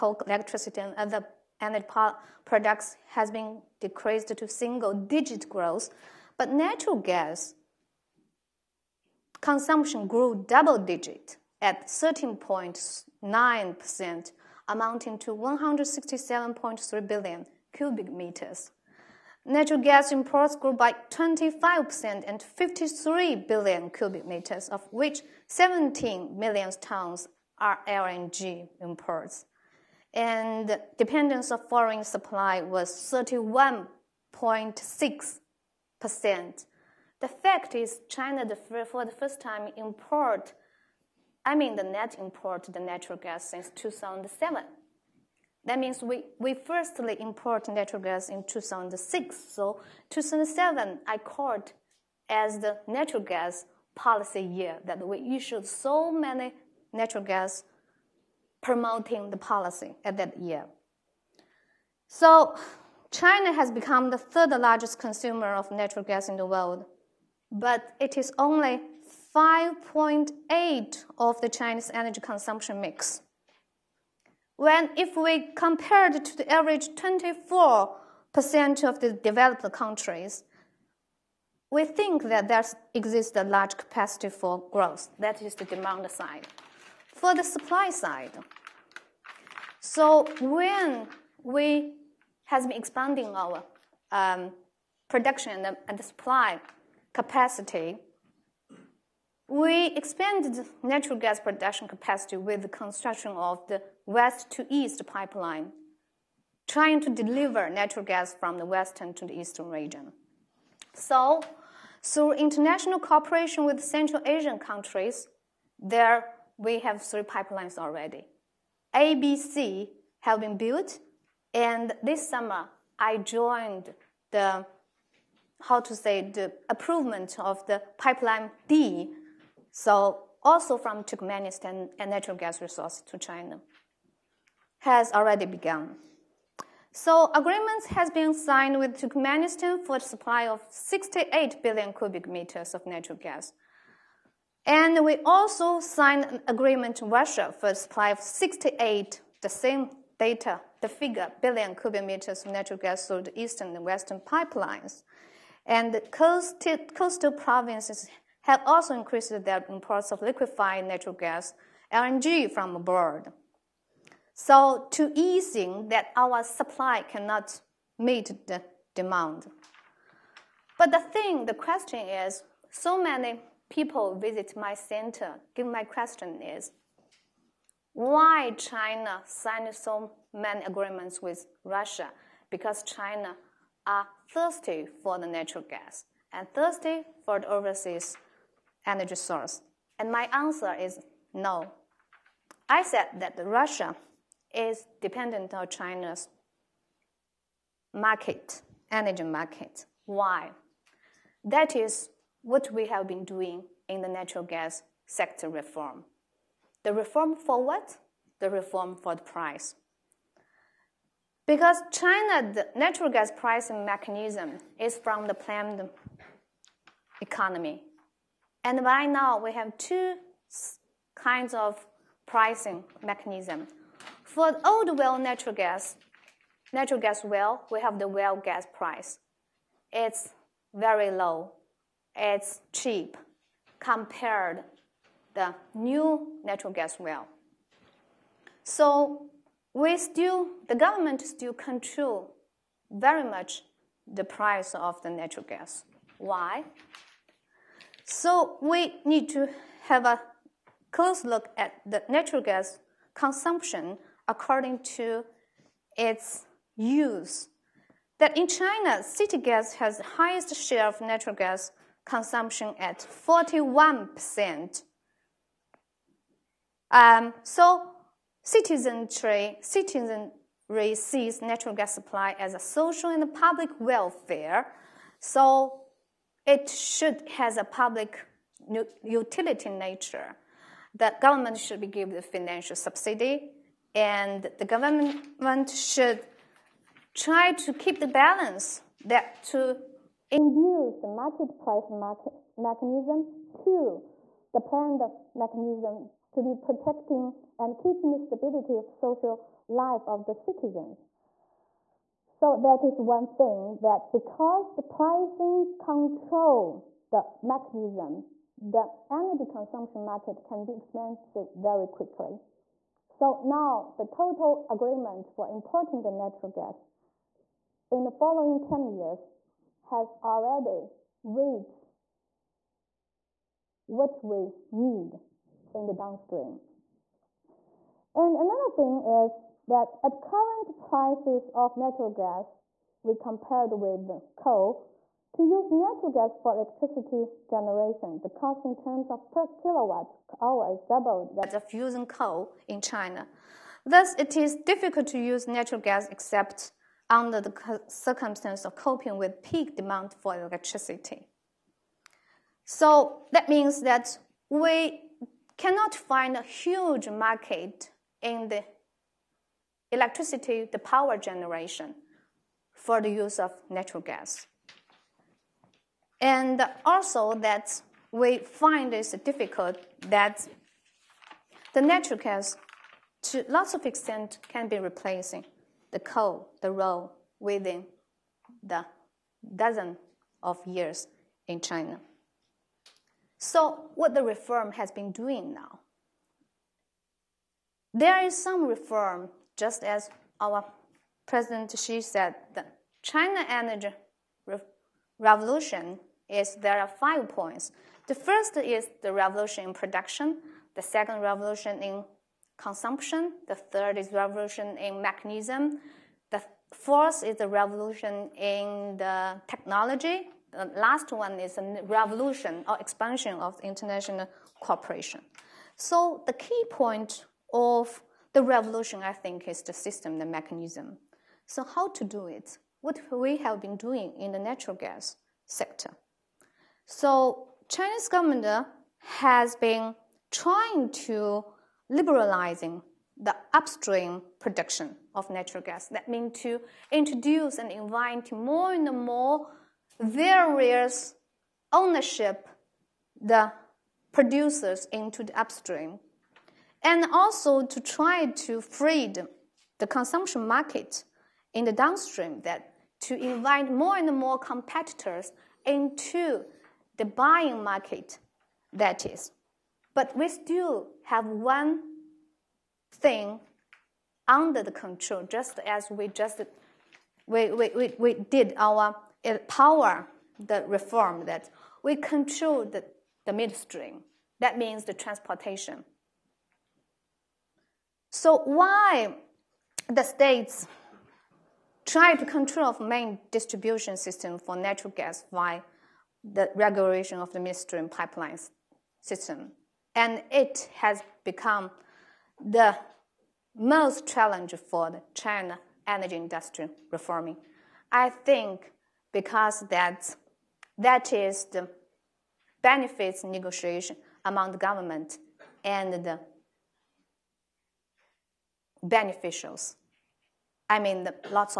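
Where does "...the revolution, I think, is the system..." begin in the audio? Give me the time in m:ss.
6:58.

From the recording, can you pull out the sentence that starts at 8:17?
I think because that that is the benefits negotiation among the government and the beneficials.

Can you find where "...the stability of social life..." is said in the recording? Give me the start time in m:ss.
4:58.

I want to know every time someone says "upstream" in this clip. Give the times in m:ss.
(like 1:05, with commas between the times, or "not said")
7:13, 7:25.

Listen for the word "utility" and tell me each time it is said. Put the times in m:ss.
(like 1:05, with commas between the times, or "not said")
4:39.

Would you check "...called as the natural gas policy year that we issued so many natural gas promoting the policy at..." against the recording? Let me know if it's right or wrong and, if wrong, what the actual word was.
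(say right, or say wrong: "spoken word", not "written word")
right.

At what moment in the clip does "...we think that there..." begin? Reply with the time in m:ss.
1:21.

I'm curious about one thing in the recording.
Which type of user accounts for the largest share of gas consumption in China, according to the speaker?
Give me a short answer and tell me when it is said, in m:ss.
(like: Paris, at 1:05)
City gas, at 4:19.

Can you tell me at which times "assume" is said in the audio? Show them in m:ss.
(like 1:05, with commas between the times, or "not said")
not said.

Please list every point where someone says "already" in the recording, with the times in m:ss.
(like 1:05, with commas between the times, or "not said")
1:57, 2:15, 5:20.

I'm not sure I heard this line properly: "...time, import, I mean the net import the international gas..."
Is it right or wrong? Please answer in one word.
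wrong.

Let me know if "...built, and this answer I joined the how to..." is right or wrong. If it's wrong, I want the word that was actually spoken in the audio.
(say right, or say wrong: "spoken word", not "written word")
wrong: "summer", not "answer".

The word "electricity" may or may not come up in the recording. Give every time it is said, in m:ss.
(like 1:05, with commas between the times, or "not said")
0:00, 5:36, 5:50, 5:59.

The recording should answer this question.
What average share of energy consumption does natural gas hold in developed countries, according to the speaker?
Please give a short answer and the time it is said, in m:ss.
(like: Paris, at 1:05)
24%, at 1:16.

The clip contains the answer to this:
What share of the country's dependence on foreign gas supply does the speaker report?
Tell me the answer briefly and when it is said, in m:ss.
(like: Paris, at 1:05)
31.6%, at 0:32.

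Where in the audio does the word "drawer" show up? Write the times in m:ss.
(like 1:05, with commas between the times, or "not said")
not said.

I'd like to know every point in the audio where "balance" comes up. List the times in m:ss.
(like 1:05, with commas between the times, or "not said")
4:48.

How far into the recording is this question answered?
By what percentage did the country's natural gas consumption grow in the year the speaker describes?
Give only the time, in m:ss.
0:11.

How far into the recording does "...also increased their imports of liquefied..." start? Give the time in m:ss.
2:38.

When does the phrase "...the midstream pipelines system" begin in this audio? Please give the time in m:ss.
8:07.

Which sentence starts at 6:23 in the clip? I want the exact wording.
So what the reform has been doing now?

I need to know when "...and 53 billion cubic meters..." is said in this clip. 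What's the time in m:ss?
0:22.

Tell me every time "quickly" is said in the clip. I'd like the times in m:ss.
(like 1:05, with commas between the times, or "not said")
5:11.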